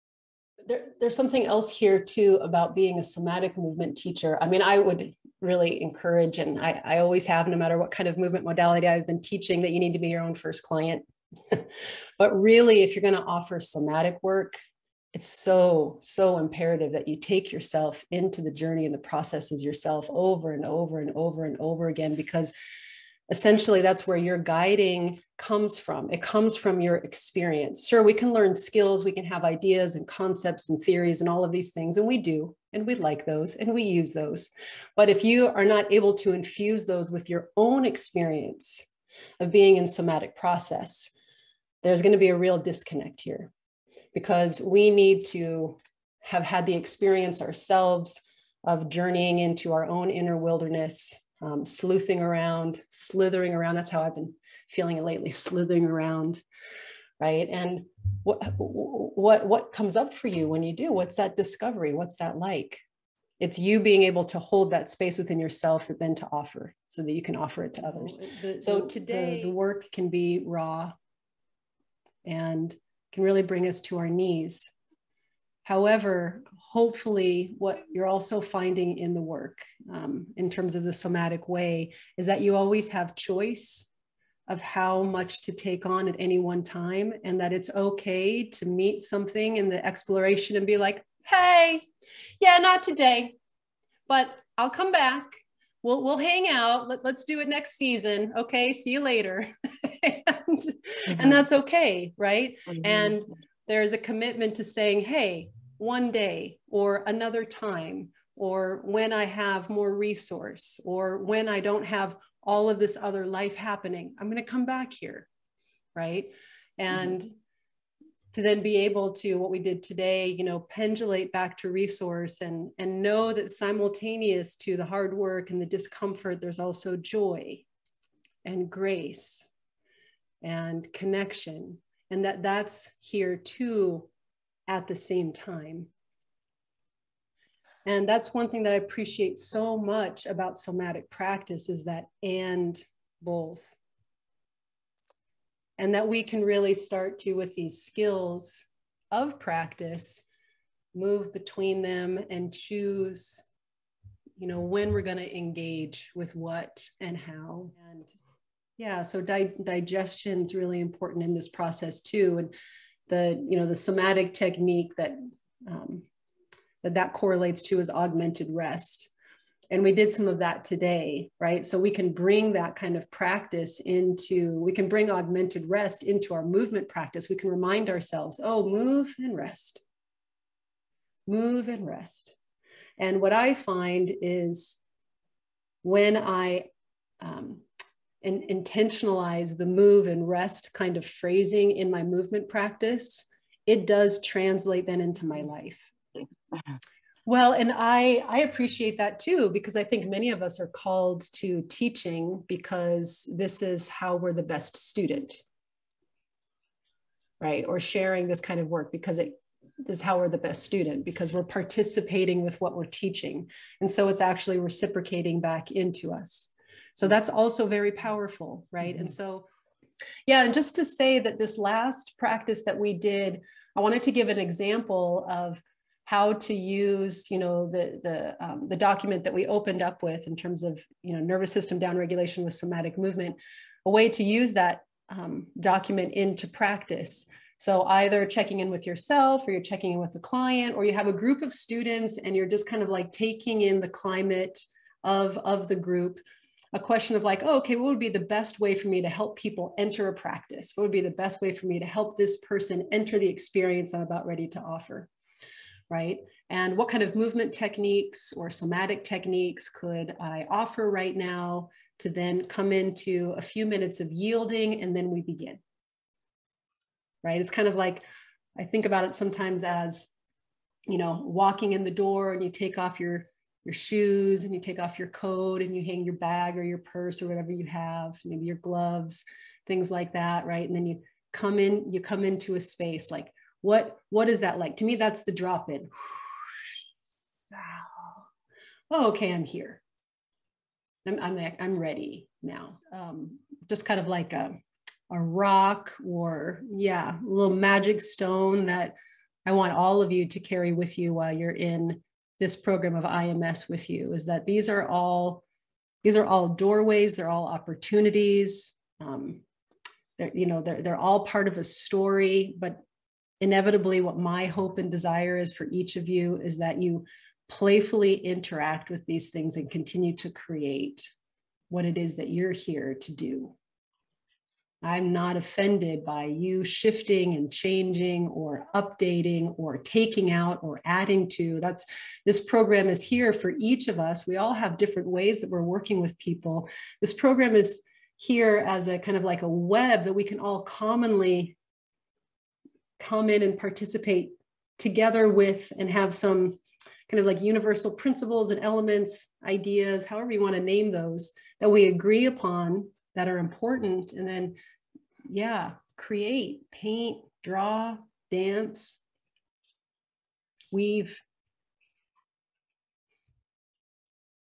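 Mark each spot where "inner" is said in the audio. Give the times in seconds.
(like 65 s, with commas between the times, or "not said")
50 s.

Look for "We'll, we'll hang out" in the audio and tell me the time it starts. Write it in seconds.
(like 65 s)
95 s.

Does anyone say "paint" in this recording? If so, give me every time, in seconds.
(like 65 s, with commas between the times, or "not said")
356 s.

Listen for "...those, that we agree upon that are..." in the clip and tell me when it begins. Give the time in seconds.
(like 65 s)
350 s.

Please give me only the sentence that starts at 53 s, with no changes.
That's how I've been feeling lately, slithering around, right?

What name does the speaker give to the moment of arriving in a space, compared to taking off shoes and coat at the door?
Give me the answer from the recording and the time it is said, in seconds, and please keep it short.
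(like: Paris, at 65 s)
The drop in, at 285 s.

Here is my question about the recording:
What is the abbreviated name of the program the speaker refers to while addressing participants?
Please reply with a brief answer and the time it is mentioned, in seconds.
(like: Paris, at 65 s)
IMS, at 303 s.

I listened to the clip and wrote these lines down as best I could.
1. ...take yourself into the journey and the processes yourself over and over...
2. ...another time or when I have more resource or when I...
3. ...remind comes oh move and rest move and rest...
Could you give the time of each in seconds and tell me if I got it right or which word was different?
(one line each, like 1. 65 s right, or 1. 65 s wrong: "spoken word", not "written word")
1. 17 s right
2. 107 s right
3. 177 s wrong: "ourselves", not "comes".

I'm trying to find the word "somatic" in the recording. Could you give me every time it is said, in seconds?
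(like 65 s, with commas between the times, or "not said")
3 s, 13 s, 39 s, 80 s, 140 s, 163 s, 232 s, 258 s.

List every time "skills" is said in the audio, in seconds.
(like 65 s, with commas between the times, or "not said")
28 s, 147 s.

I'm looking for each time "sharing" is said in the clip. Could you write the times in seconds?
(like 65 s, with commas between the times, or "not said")
207 s.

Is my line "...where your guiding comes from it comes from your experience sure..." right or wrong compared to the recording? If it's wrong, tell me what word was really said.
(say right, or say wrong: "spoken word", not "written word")
right.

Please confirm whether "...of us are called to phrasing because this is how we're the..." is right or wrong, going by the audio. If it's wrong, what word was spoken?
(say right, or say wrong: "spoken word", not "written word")
wrong: "teaching", not "phrasing".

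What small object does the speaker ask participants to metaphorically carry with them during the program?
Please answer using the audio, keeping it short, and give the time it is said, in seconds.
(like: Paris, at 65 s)
A little magic stone, at 297 s.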